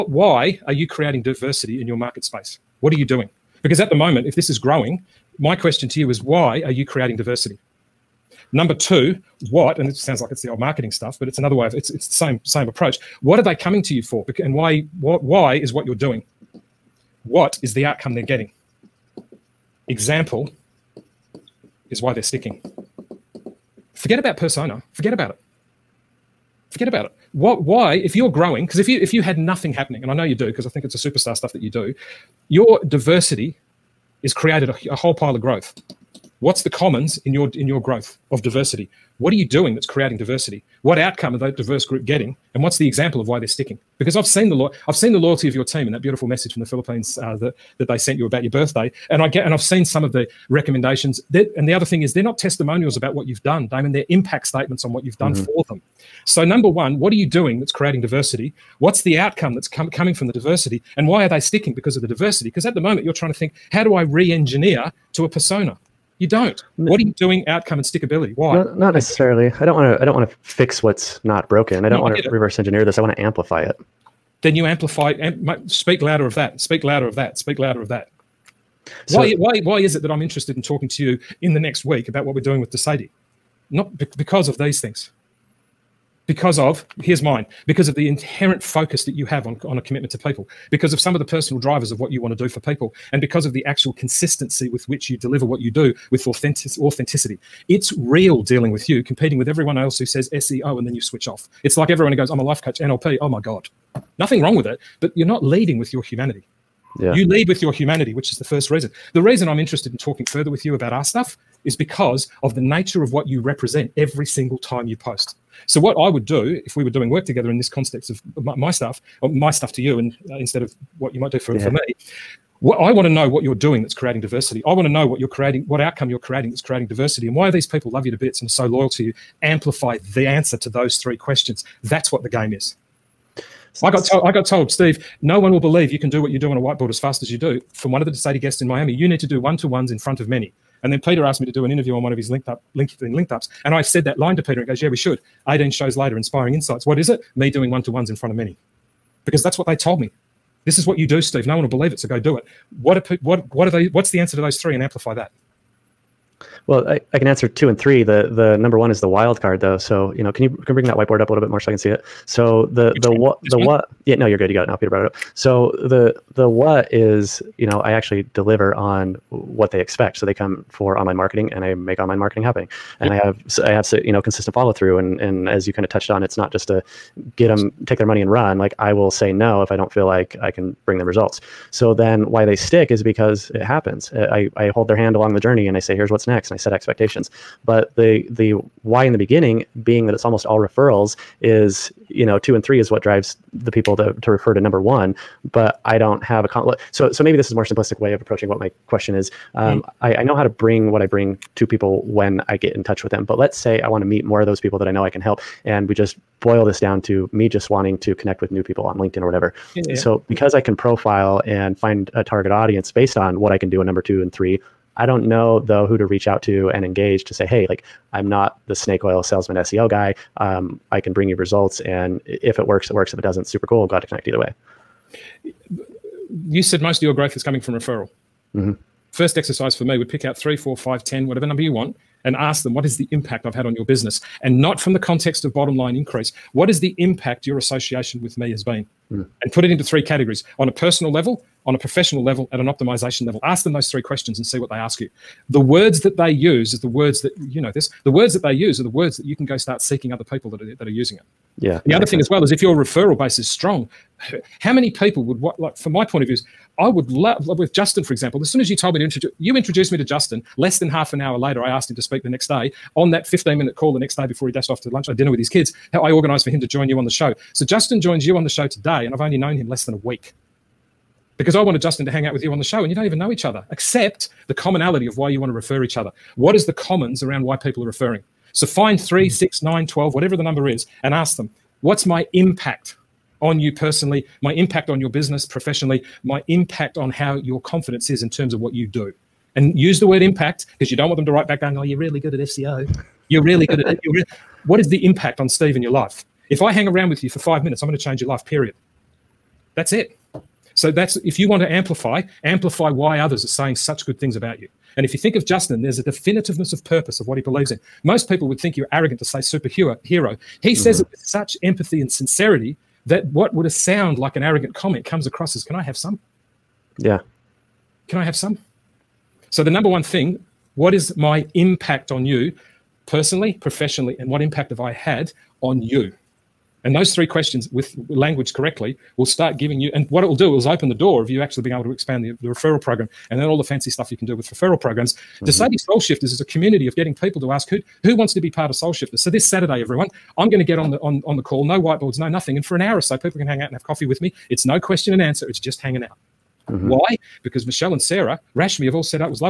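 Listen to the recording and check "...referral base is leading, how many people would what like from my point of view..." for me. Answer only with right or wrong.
wrong.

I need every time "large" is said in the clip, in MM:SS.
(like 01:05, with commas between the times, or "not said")
not said.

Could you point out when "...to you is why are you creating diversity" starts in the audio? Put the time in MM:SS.
00:05.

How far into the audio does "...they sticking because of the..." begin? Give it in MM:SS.
01:01.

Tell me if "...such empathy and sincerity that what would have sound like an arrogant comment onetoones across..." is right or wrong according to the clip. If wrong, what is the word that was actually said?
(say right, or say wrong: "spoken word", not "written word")
wrong: "comes", not "onetoones".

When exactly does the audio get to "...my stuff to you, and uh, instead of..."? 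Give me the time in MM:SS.
01:59.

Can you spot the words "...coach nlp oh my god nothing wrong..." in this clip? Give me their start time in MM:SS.
01:42.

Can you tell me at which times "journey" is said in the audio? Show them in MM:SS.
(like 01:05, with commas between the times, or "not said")
03:05.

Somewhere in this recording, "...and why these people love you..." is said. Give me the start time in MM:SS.
02:07.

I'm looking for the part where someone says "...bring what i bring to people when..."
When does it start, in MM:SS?
03:20.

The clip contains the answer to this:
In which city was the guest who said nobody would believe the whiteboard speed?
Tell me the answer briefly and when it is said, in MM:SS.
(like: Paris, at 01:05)
Miami, at 02:18.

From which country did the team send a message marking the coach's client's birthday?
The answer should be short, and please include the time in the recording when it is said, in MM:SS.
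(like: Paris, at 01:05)
Philippines, at 00:46.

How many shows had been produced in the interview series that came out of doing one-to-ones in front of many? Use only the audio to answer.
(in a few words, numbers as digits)
18.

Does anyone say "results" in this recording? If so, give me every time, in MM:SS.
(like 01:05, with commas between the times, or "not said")
03:01, 03:41.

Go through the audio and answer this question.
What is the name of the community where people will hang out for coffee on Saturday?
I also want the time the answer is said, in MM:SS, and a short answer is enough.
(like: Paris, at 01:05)
De Sede Soul Shifters, at 05:35.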